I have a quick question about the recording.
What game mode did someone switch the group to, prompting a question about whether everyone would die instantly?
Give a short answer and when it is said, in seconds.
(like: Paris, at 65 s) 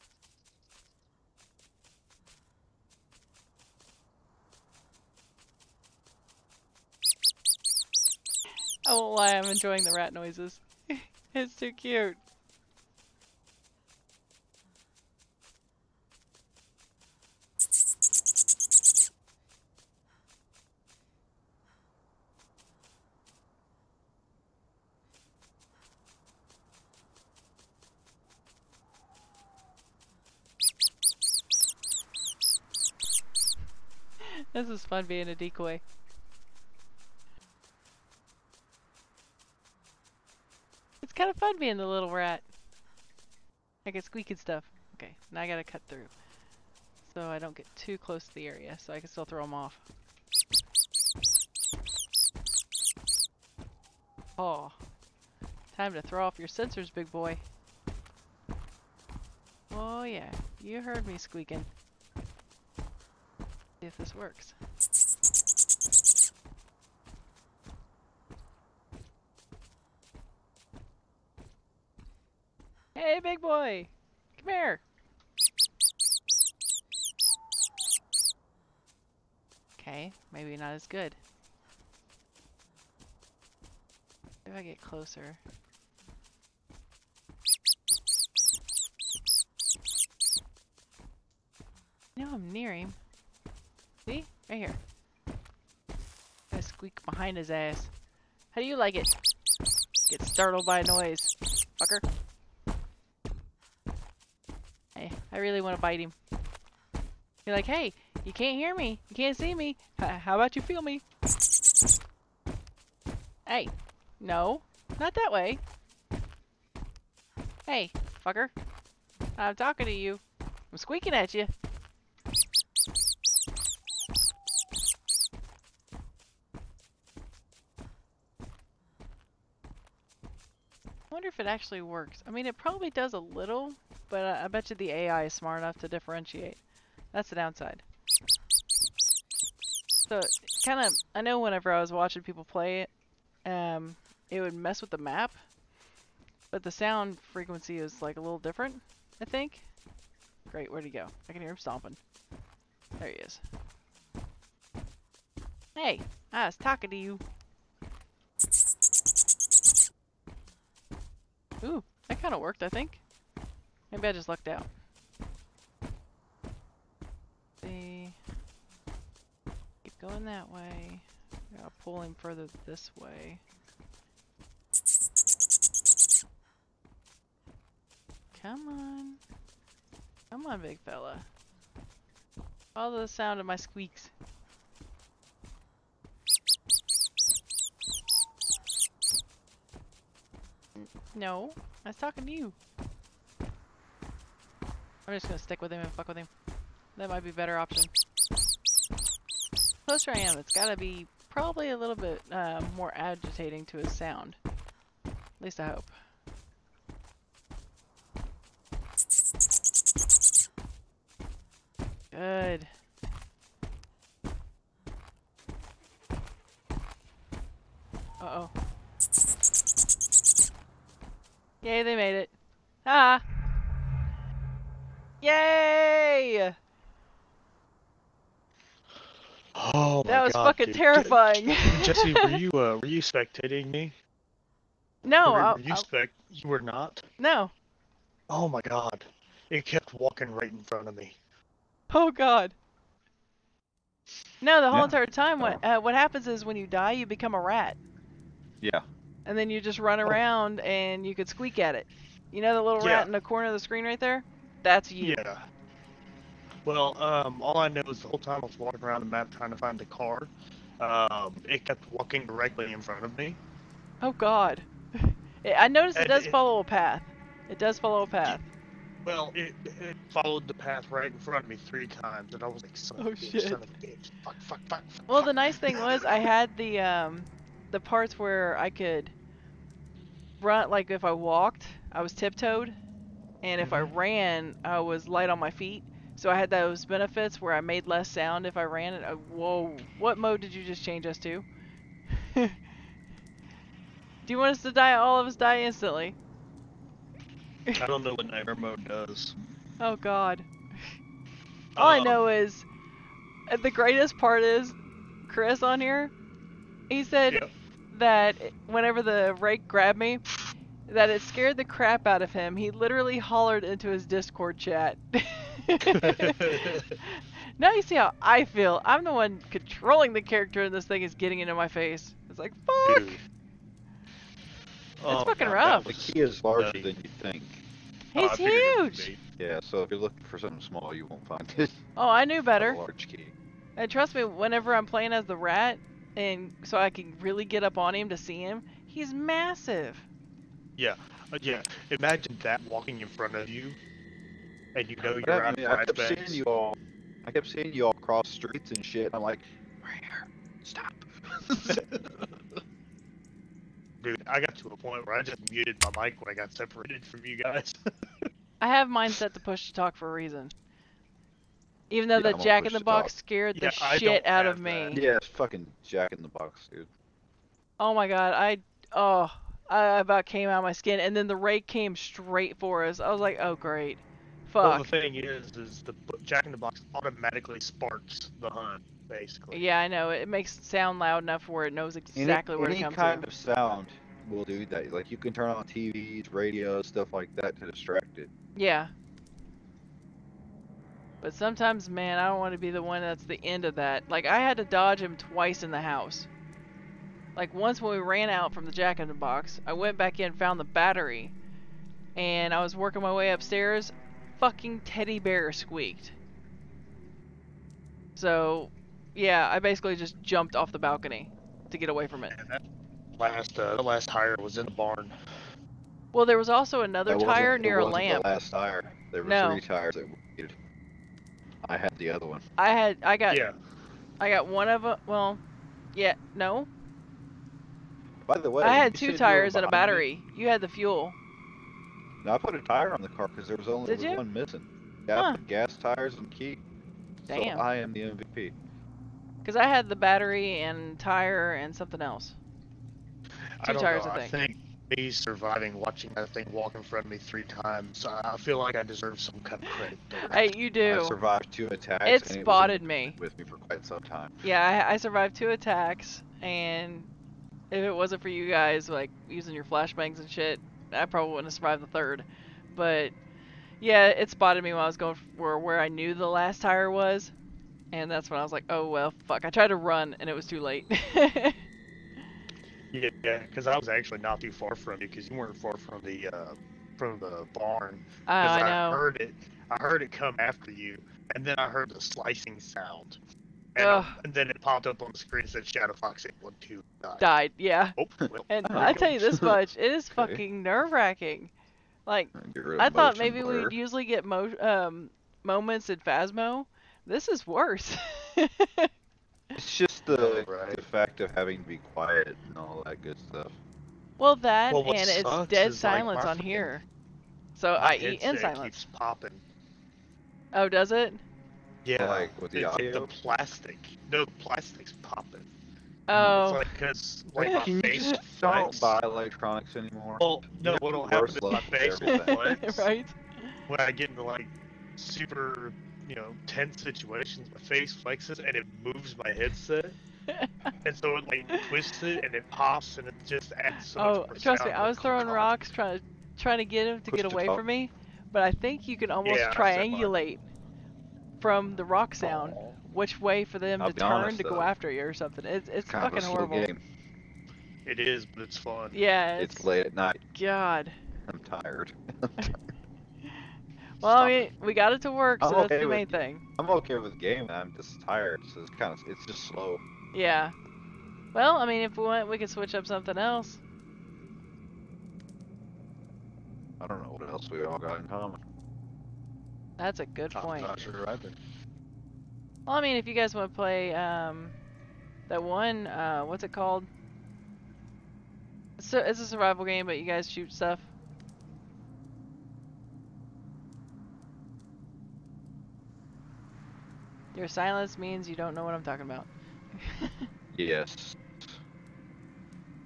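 nightmare mode, at 298 s.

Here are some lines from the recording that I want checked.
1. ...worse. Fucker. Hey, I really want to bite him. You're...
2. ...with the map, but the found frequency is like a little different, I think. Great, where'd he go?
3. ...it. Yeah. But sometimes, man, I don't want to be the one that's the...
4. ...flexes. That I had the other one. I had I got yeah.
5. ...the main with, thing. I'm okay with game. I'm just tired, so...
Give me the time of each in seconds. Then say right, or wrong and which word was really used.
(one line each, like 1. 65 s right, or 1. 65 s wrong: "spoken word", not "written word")
1. 100 s wrong: "noise", not "worse"
2. 144 s wrong: "sound", not "found"
3. 388 s right
4. 419 s wrong: "tires", not "flexes"
5. 555 s right.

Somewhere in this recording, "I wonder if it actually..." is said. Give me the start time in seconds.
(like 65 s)
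131 s.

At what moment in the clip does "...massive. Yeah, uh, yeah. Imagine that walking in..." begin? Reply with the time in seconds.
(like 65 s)
339 s.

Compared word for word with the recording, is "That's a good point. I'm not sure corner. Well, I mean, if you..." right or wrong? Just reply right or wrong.
wrong.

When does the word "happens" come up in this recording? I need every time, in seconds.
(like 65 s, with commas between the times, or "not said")
245 s, 521 s.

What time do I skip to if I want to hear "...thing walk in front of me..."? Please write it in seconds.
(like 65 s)
446 s.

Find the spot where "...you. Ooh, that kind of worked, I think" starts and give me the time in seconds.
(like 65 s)
156 s.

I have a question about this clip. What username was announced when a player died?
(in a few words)
ShadowFox812.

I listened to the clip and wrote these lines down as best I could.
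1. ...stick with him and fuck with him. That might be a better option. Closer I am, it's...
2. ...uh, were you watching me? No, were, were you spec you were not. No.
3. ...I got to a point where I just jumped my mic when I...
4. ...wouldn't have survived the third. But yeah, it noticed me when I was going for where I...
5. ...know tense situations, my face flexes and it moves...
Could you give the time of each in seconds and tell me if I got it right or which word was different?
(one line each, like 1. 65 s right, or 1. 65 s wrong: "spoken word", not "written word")
1. 195 s right
2. 232 s wrong: "spectating", not "watching"
3. 354 s wrong: "muted", not "jumped"
4. 461 s wrong: "spotted", not "noticed"
5. 526 s right.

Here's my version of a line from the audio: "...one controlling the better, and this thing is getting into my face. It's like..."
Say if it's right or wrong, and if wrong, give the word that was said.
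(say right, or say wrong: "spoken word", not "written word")
wrong: "character", not "better".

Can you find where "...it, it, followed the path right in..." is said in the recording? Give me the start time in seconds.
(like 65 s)
269 s.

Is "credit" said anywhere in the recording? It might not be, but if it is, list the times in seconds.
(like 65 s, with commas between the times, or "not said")
449 s.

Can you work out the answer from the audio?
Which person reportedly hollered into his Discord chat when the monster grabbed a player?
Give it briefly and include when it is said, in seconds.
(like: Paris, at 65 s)
Chris, at 305 s.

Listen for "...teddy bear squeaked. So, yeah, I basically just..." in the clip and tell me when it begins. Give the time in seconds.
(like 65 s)
404 s.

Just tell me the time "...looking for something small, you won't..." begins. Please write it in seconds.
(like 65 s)
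329 s.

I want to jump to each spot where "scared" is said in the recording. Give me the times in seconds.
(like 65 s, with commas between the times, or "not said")
311 s, 363 s.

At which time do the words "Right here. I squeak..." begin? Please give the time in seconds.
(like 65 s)
94 s.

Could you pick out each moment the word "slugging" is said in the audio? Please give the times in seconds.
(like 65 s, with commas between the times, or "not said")
not said.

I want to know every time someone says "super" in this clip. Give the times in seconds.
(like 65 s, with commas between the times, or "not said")
524 s.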